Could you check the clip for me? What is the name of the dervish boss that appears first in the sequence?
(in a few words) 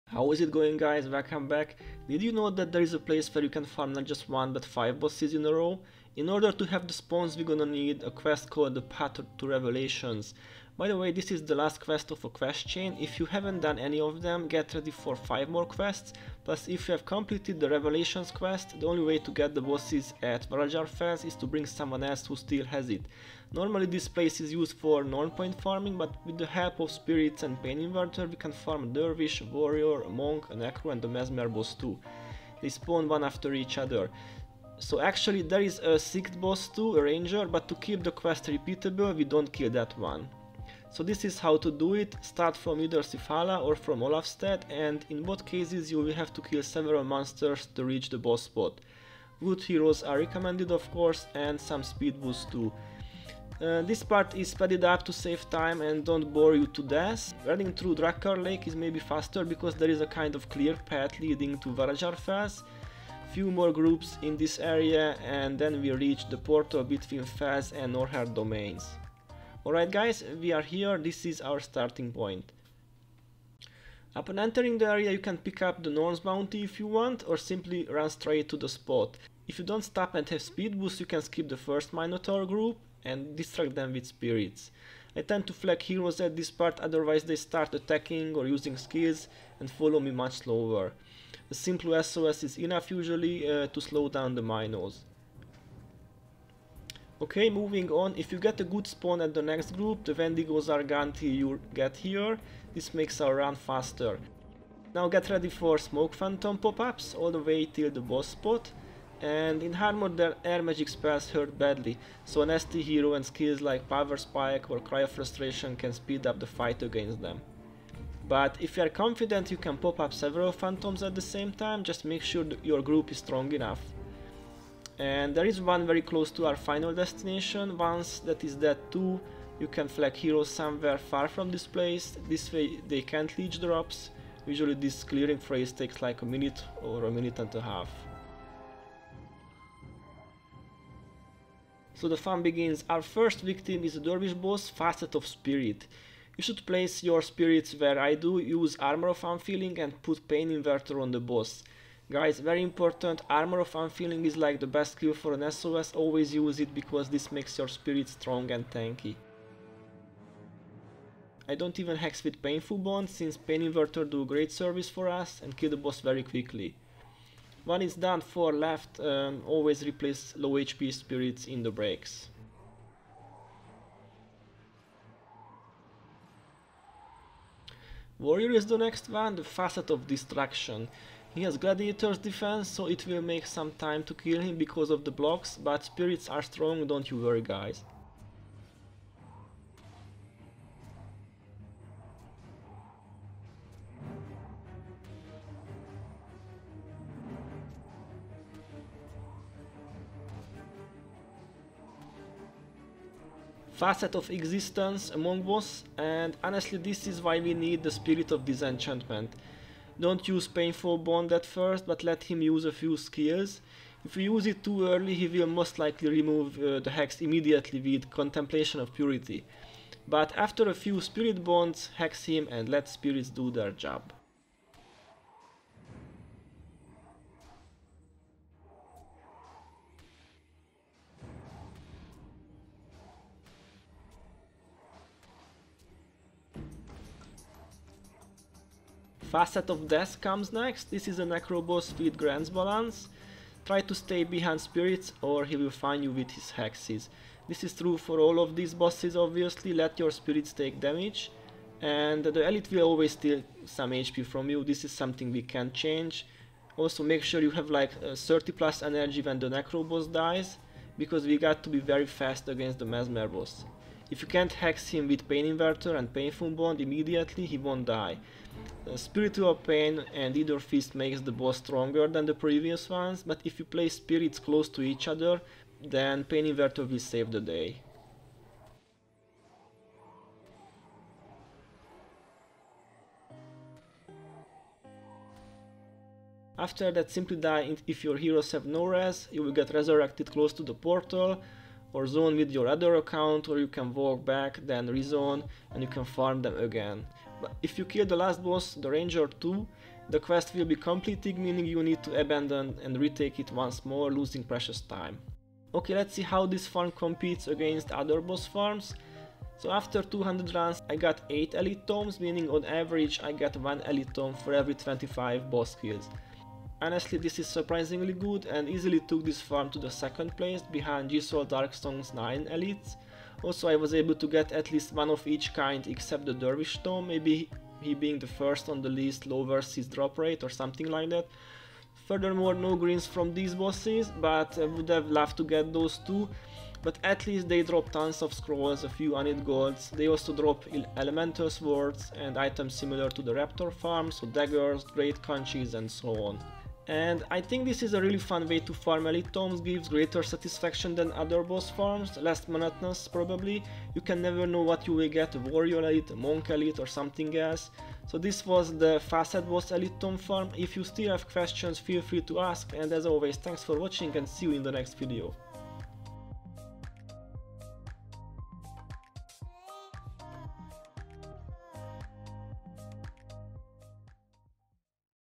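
Facet of Spirit.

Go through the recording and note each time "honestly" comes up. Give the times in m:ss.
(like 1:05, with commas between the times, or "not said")
3:26, 5:16.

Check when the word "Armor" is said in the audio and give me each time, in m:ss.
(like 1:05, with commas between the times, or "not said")
1:49, 2:28, 2:33.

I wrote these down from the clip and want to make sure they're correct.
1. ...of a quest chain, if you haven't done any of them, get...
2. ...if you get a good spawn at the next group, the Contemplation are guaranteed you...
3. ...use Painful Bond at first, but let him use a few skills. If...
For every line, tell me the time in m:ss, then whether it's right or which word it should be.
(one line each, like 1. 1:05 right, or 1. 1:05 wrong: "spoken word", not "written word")
1. 0:12 right
2. 1:38 wrong: "Wendigos", not "Contemplation"
3. 3:30 right.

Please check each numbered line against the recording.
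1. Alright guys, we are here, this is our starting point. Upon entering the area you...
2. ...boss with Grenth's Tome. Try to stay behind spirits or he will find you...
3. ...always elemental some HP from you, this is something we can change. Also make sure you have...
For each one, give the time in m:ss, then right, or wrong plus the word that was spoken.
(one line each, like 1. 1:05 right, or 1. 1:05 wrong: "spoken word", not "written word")
1. 1:09 right
2. 4:01 wrong: "Balance", not "Tome"
3. 4:12 wrong: "steal", not "elemental".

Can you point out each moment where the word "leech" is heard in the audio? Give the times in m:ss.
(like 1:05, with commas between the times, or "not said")
2:13.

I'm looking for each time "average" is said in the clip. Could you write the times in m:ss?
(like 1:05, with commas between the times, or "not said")
5:12.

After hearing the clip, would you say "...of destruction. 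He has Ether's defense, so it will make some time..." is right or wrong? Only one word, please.
wrong.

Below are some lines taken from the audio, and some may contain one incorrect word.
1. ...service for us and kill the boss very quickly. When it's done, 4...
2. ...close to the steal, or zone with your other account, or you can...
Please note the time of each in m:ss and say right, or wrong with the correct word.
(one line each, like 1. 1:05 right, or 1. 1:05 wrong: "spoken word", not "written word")
1. 2:44 right
2. 4:50 wrong: "portal", not "steal".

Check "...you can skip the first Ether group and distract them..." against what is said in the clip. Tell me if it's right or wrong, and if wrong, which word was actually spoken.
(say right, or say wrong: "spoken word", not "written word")
wrong: "Minotaur", not "Ether".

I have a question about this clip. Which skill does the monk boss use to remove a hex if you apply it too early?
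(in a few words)
Contemplation of Purity.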